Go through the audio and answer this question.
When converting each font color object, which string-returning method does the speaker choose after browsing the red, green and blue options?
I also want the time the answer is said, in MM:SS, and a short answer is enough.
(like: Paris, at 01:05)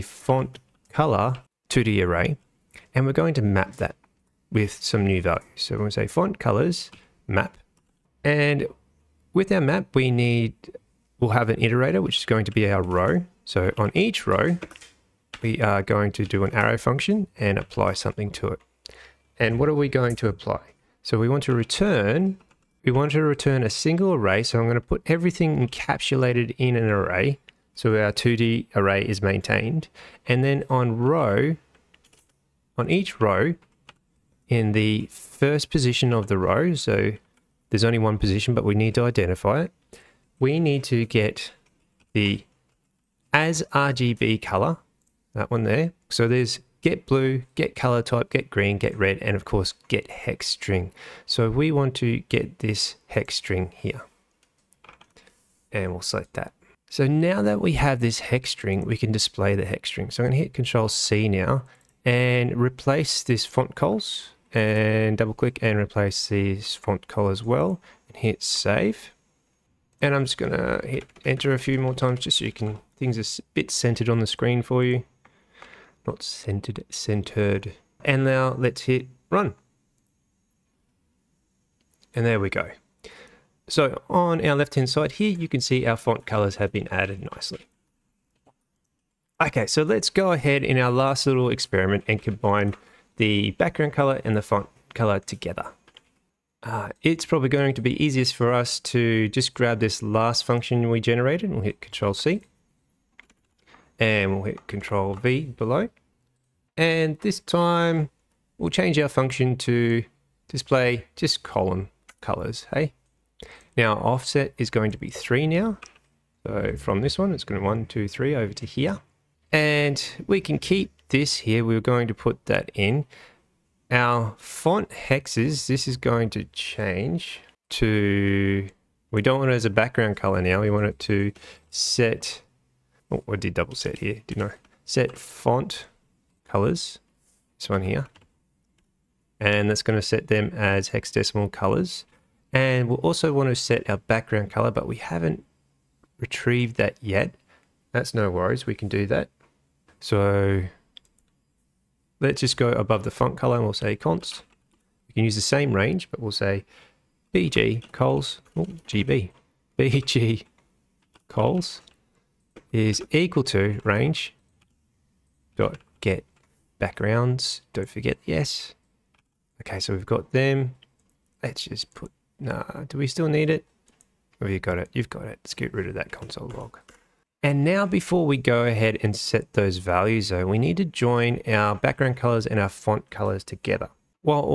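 get hex string, at 00:49.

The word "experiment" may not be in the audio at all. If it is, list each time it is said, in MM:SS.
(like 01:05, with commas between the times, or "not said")
01:31.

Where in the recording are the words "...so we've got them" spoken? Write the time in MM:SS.
02:49.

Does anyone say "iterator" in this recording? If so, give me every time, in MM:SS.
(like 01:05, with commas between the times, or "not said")
00:11.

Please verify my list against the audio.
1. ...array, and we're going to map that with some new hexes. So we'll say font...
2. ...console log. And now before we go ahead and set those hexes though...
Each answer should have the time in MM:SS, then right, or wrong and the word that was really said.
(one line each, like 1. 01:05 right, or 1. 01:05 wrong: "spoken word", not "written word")
1. 00:02 wrong: "values", not "hexes"
2. 02:56 wrong: "values", not "hexes".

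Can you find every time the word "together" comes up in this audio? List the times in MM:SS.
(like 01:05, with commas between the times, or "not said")
01:35, 03:03.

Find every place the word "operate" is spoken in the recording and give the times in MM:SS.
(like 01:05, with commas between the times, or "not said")
not said.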